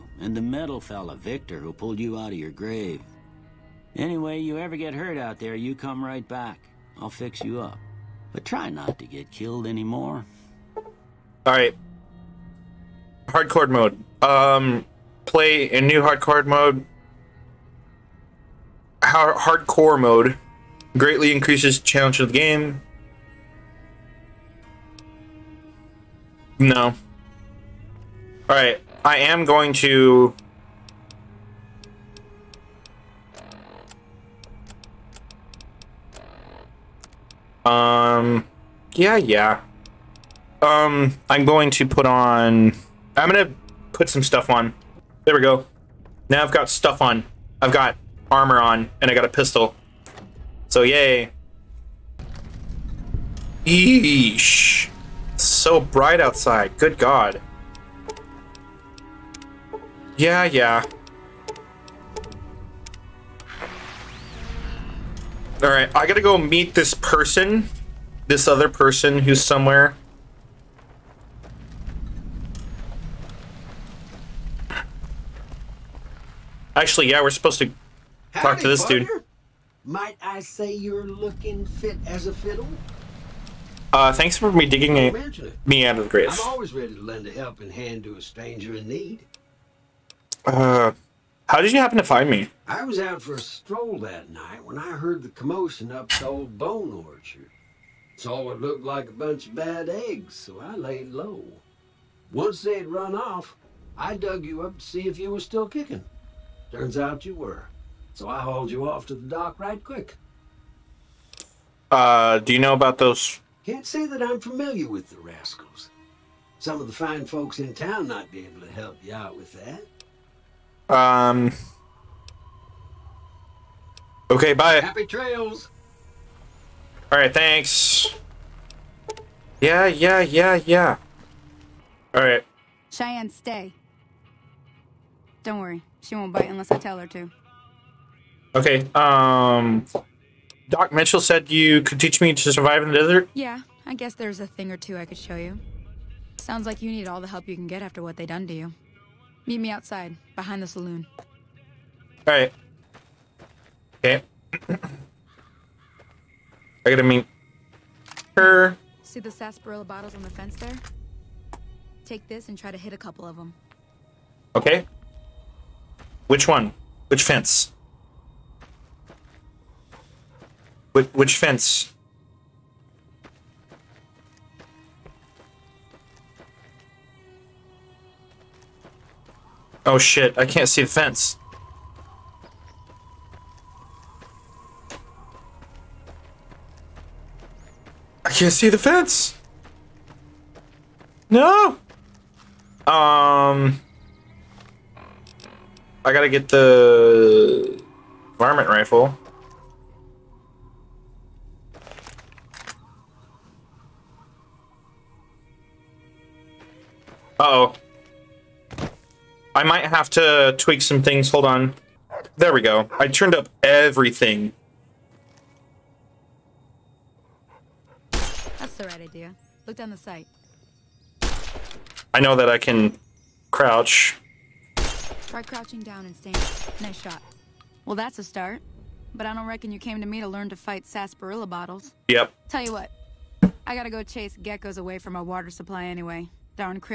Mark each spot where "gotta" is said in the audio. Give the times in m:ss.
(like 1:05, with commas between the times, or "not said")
1:06, 2:36, 3:16, 3:53.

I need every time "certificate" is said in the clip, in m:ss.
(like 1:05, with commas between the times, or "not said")
not said.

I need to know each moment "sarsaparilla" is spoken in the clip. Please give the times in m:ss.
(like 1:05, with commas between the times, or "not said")
2:39, 3:50.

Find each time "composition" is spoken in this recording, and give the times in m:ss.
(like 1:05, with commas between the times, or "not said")
not said.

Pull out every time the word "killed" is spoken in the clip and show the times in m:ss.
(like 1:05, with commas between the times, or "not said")
0:09.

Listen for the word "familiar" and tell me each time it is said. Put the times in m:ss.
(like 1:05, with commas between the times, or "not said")
1:54.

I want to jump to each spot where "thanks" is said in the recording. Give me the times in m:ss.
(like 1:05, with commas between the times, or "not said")
1:24, 2:07.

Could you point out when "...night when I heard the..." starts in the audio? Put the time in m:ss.
1:34.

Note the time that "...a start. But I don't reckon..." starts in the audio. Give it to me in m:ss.
3:48.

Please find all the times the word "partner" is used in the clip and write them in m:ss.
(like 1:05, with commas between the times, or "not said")
1:18.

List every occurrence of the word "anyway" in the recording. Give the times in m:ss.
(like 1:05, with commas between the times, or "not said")
0:03, 3:55.